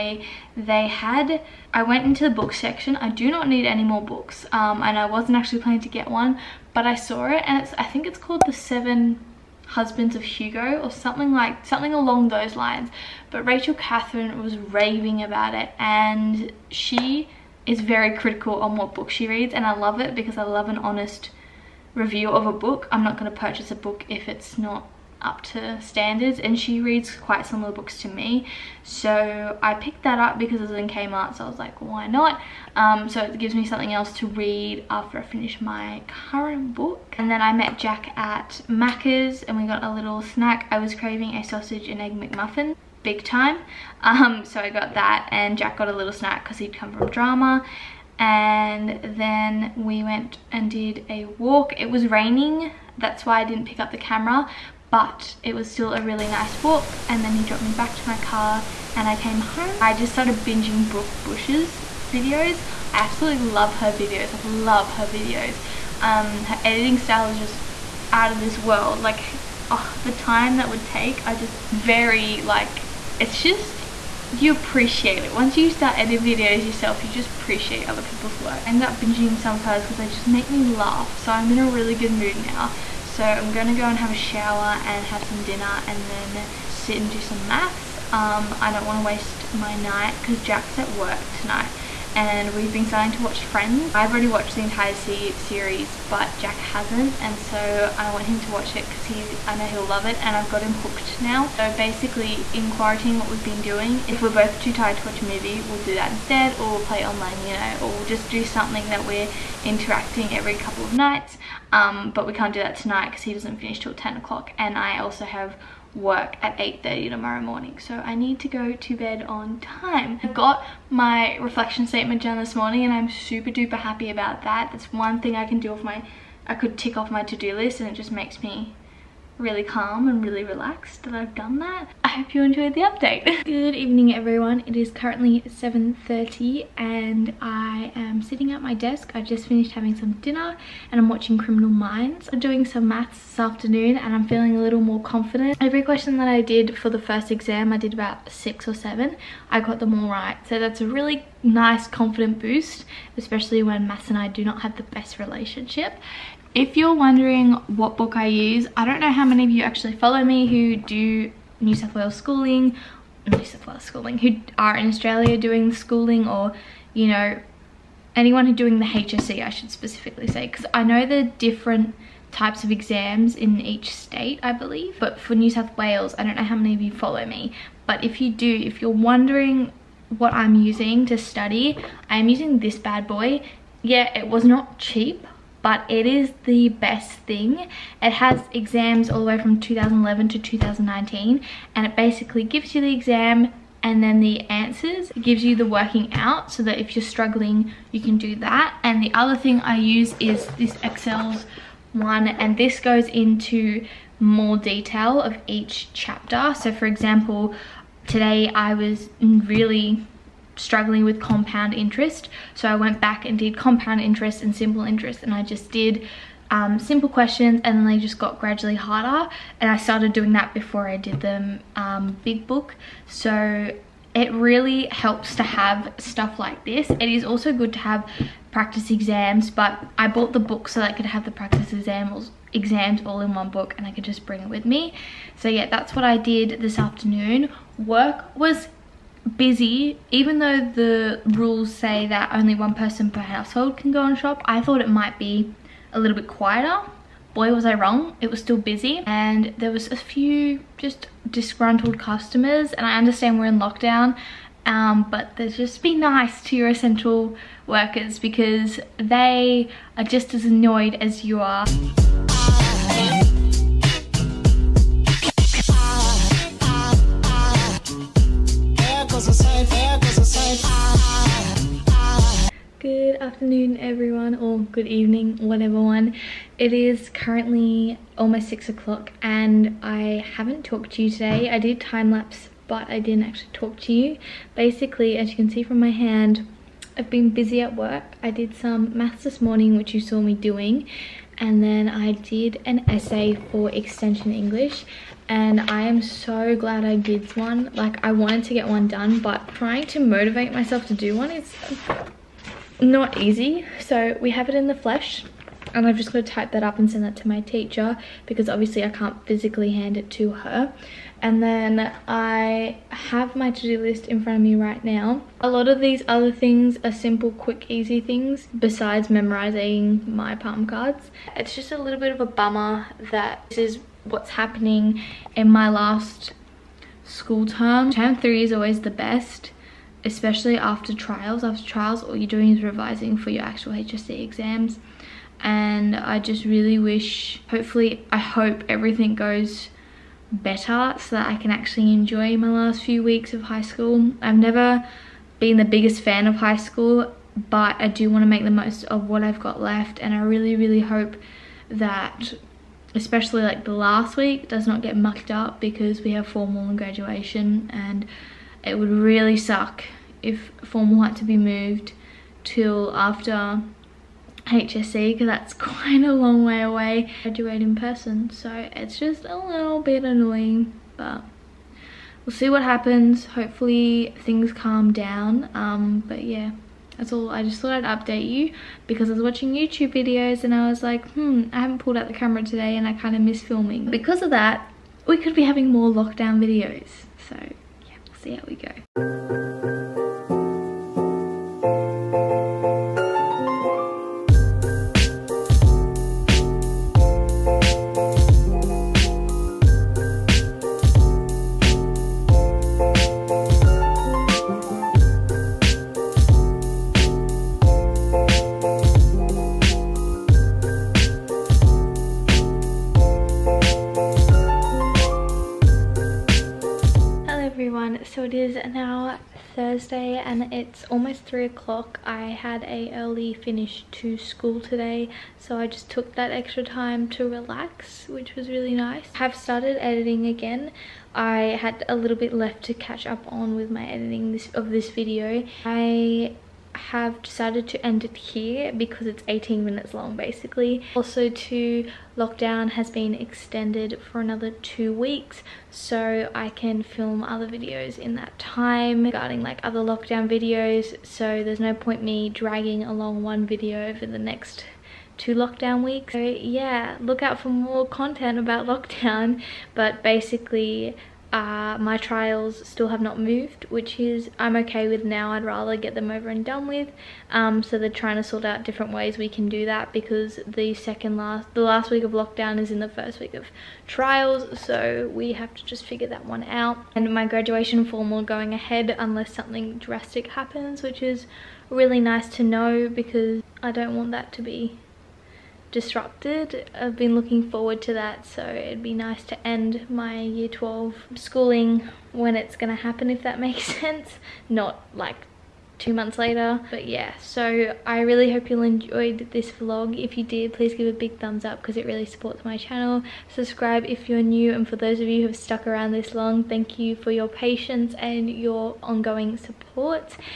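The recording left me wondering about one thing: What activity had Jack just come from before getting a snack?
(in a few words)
drama.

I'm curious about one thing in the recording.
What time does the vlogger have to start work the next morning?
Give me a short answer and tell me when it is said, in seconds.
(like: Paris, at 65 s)
8:30, at 116 s.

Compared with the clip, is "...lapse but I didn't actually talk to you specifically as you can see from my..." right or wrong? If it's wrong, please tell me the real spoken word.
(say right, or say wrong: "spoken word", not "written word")
wrong: "basically", not "specifically".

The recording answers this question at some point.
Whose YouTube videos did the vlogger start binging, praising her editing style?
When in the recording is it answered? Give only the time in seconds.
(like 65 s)
60 s.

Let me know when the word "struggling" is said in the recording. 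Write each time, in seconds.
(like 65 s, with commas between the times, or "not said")
197 s, 210 s.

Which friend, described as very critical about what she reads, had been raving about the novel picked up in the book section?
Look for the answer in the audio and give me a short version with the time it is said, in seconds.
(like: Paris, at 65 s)
Rachel Catherine, at 13 s.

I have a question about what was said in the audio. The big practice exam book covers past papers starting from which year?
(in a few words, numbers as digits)
2011.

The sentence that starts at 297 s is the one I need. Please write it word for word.
Like I wanted to get one done but trying to motivate myself to do one is not easy.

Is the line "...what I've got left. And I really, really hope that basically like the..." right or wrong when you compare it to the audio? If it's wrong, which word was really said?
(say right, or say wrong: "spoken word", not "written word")
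wrong: "especially", not "basically".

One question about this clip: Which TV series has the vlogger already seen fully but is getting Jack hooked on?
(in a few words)
Friends.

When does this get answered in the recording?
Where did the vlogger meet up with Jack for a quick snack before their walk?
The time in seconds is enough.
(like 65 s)
38 s.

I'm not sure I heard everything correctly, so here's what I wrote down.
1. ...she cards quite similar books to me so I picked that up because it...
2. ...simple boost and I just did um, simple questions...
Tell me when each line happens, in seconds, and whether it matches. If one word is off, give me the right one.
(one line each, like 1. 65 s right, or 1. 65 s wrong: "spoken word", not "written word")
1. 26 s wrong: "reads", not "cards"
2. 214 s wrong: "interest", not "boost".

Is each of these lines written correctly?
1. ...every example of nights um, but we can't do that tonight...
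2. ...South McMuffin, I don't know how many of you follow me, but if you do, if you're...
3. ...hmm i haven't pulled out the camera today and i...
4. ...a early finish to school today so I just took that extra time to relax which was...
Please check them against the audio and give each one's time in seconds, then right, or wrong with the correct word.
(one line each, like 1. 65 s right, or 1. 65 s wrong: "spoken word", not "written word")
1. 110 s wrong: "couple", not "example"
2. 175 s wrong: "Wales", not "McMuffin"
3. 381 s right
4. 422 s right.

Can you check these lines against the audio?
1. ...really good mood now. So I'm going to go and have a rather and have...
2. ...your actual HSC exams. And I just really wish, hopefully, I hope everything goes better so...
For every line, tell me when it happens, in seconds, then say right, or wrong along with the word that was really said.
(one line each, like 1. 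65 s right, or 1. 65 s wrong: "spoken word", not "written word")
1. 81 s wrong: "shower", not "rather"
2. 333 s right.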